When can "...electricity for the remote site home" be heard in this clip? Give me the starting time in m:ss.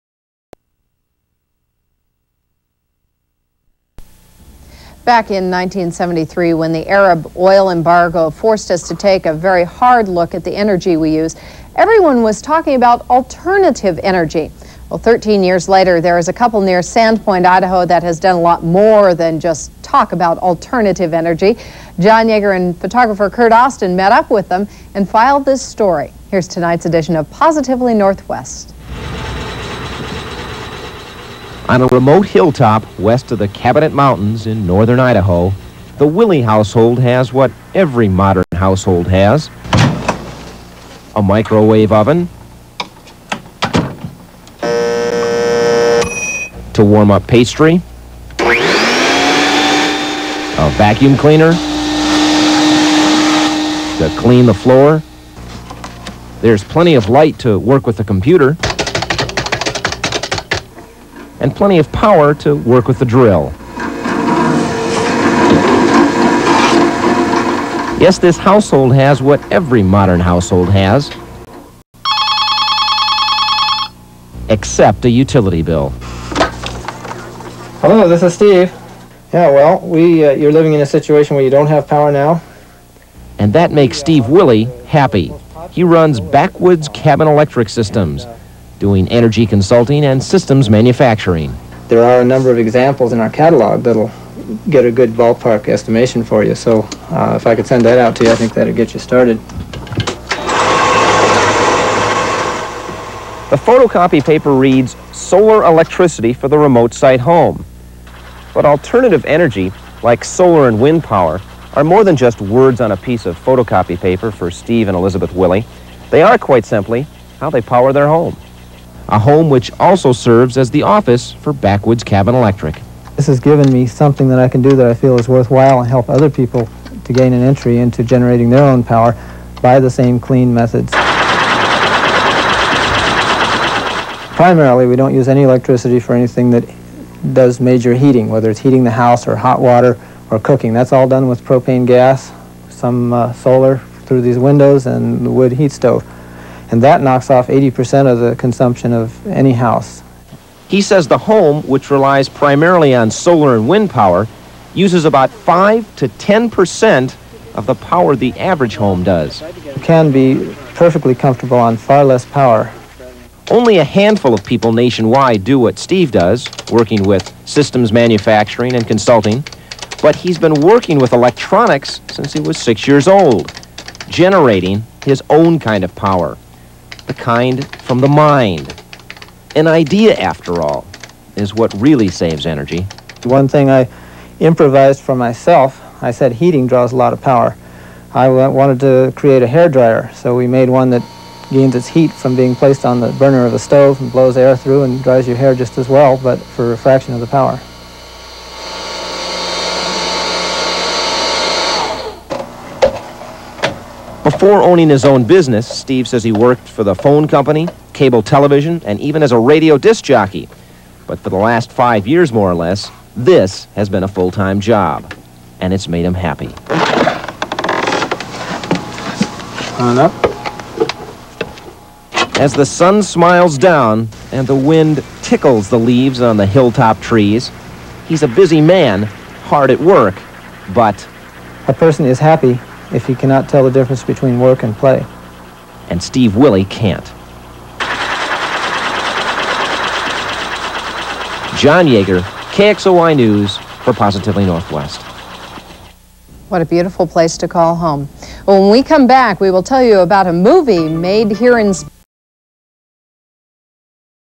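1:45.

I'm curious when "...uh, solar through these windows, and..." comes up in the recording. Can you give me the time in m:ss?
2:23.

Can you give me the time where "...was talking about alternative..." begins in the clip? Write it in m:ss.
0:12.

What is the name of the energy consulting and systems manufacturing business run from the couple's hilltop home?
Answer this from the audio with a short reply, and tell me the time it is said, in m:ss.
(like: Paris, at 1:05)
Backwoods Cabin Electric Systems, at 1:26.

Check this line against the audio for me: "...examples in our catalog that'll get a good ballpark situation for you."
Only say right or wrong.
wrong.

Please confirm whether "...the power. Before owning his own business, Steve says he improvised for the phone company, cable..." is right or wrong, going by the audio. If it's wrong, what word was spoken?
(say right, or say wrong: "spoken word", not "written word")
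wrong: "worked", not "improvised".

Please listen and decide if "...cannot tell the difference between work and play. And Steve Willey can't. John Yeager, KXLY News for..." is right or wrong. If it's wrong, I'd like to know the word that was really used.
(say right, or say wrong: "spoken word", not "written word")
right.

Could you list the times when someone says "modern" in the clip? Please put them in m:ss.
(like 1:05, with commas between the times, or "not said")
0:38, 1:09.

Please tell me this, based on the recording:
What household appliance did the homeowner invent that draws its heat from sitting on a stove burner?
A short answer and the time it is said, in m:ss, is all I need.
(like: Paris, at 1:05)
Hair dryer, at 3:09.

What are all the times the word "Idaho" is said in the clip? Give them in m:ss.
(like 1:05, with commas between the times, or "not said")
0:17, 0:34.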